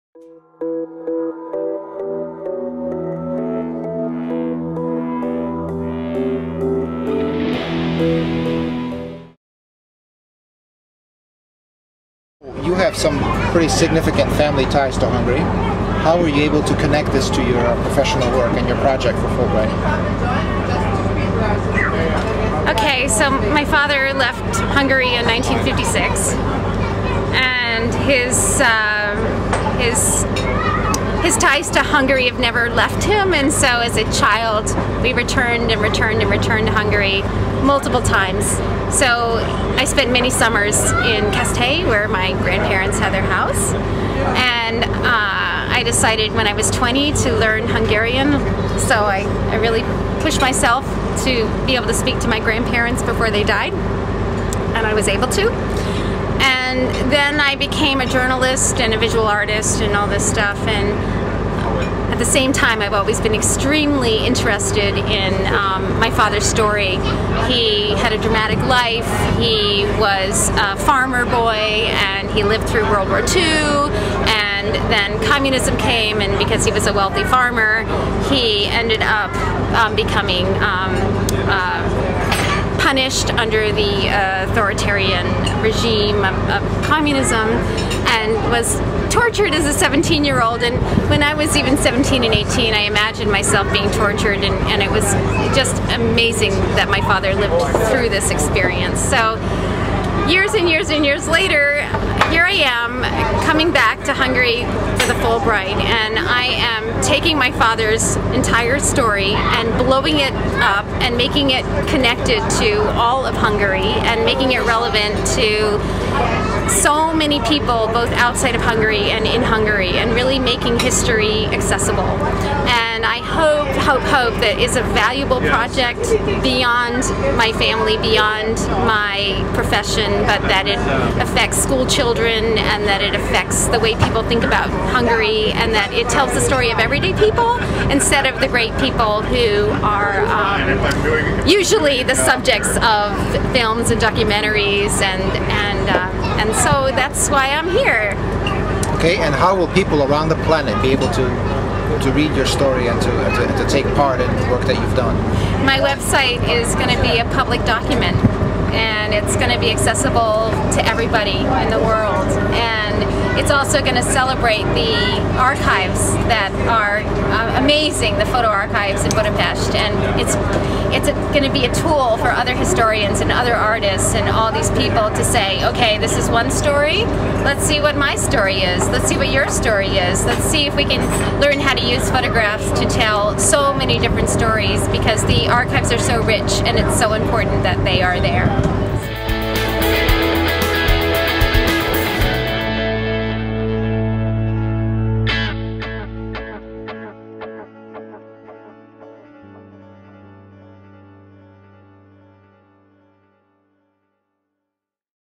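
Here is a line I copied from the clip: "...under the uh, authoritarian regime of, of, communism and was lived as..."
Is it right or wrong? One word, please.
wrong.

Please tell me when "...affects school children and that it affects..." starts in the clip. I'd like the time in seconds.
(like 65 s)
131 s.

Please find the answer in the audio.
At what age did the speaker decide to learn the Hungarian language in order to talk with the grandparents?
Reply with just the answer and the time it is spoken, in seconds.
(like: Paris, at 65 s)
20, at 46 s.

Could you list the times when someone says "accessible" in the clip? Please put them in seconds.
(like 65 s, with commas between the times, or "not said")
121 s, 159 s.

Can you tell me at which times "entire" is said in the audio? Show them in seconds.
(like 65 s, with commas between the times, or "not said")
108 s.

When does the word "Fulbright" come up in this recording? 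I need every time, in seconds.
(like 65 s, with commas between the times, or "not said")
19 s, 105 s.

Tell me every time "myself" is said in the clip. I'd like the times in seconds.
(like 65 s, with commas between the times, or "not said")
50 s, 93 s.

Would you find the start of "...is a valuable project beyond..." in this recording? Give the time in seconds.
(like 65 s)
124 s.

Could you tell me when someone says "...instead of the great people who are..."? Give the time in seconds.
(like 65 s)
137 s.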